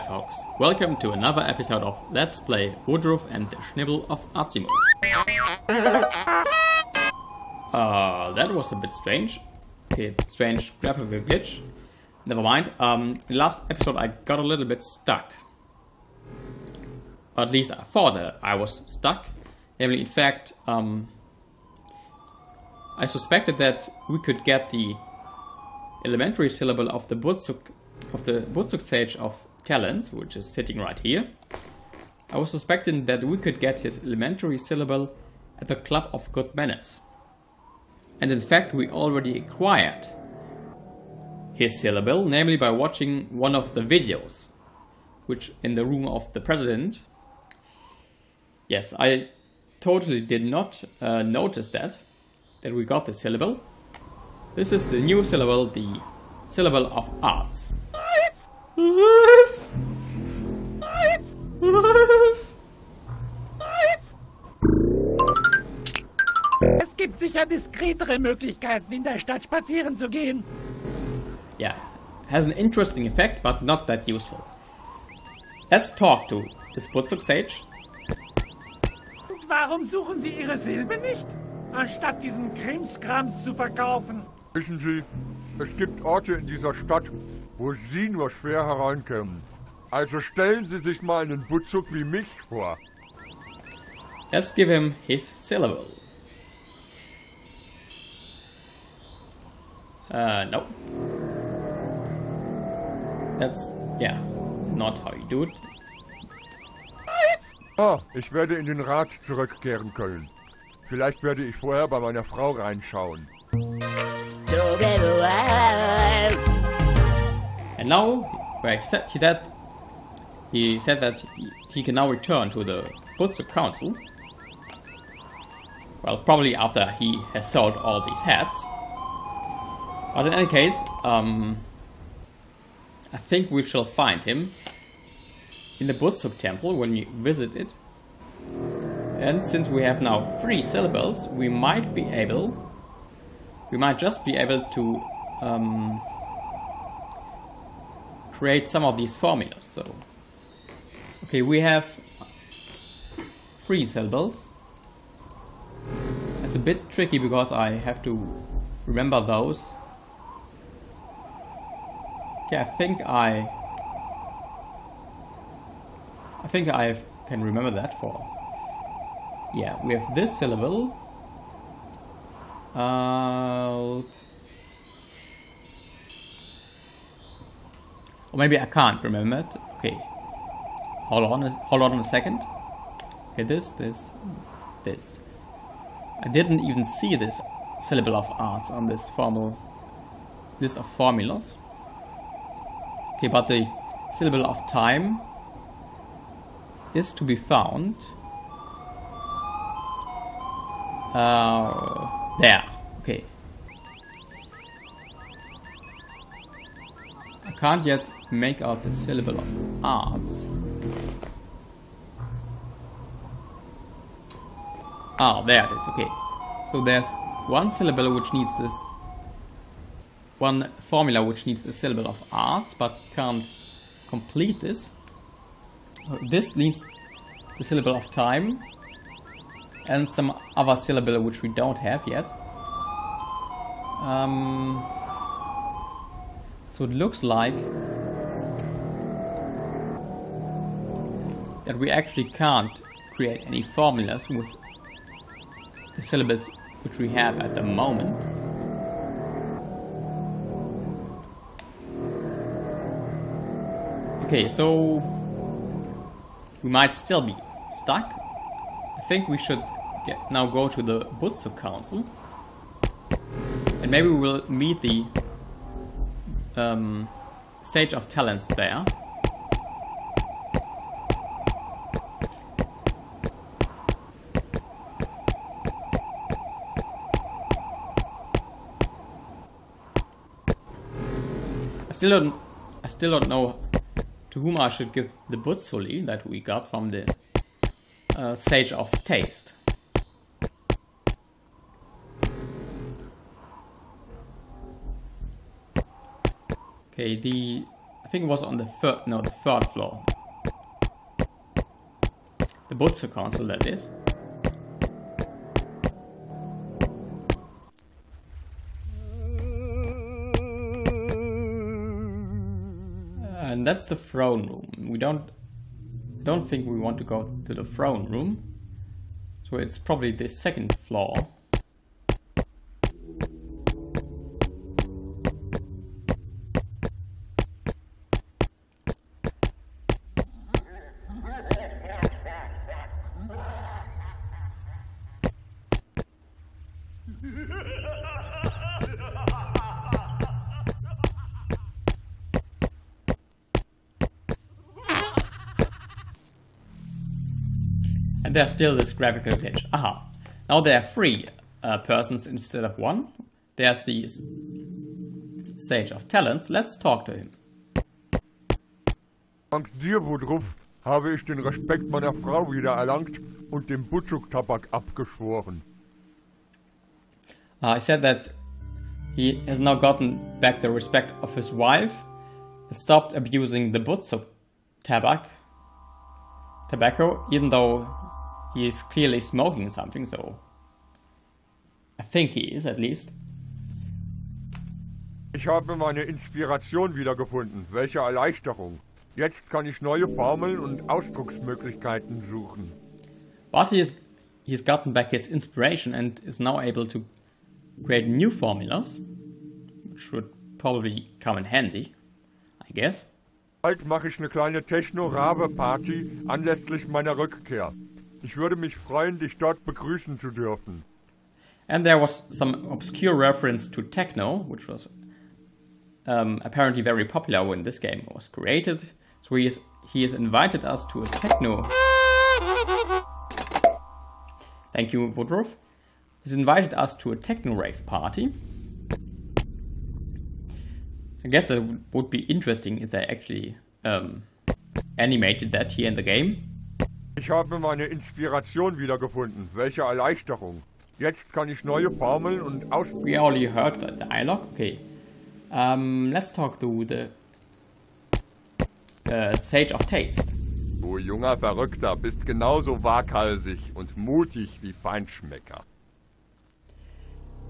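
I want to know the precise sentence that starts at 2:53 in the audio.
Uh, or maybe I can't remember it.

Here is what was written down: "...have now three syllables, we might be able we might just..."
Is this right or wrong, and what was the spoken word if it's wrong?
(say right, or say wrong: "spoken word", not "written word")
right.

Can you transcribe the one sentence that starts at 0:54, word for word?
This is the new syllable, the syllable of arts.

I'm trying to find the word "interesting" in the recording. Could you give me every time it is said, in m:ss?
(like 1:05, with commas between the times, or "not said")
1:12, 7:12.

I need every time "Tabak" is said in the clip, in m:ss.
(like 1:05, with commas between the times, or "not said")
6:03, 6:13.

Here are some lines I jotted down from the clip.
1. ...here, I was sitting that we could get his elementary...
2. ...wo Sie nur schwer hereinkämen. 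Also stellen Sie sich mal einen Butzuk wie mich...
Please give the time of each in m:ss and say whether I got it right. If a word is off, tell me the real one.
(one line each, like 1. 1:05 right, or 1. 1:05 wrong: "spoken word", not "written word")
1. 0:30 wrong: "suspecting", not "sitting"
2. 1:27 right.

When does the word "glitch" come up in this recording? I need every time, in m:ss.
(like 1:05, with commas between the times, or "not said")
0:11, 5:49.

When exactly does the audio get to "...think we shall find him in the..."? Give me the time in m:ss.
2:13.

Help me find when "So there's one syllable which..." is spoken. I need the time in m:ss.
3:36.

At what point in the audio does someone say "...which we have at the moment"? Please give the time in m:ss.
4:06.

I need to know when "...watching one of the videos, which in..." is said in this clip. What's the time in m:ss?
0:42.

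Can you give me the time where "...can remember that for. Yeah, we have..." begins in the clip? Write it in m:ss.
2:47.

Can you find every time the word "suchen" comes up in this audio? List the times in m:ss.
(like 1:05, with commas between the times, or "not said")
1:19, 6:32.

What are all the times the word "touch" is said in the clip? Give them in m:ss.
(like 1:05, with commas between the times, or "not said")
not said.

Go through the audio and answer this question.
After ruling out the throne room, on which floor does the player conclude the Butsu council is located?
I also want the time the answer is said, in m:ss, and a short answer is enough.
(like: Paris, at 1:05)
second floor, at 5:20.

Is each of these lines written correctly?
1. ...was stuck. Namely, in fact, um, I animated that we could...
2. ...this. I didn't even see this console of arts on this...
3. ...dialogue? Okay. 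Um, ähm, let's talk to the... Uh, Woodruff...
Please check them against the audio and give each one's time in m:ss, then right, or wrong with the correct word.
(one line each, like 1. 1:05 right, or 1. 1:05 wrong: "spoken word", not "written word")
1. 0:18 wrong: "suspected", not "animated"
2. 3:04 wrong: "syllable", not "console"
3. 7:24 wrong: "Sage", not "Woodruff".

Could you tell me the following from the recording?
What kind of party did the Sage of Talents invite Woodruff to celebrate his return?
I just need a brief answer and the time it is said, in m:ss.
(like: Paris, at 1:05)
techno rave party, at 7:07.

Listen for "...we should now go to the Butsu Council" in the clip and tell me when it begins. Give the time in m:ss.
4:19.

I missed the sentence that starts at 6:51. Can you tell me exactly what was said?
And there was some obscure reference to techno, which was um, apparently very popular when this game was created.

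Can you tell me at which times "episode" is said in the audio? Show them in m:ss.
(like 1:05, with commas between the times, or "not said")
0:01, 0:13.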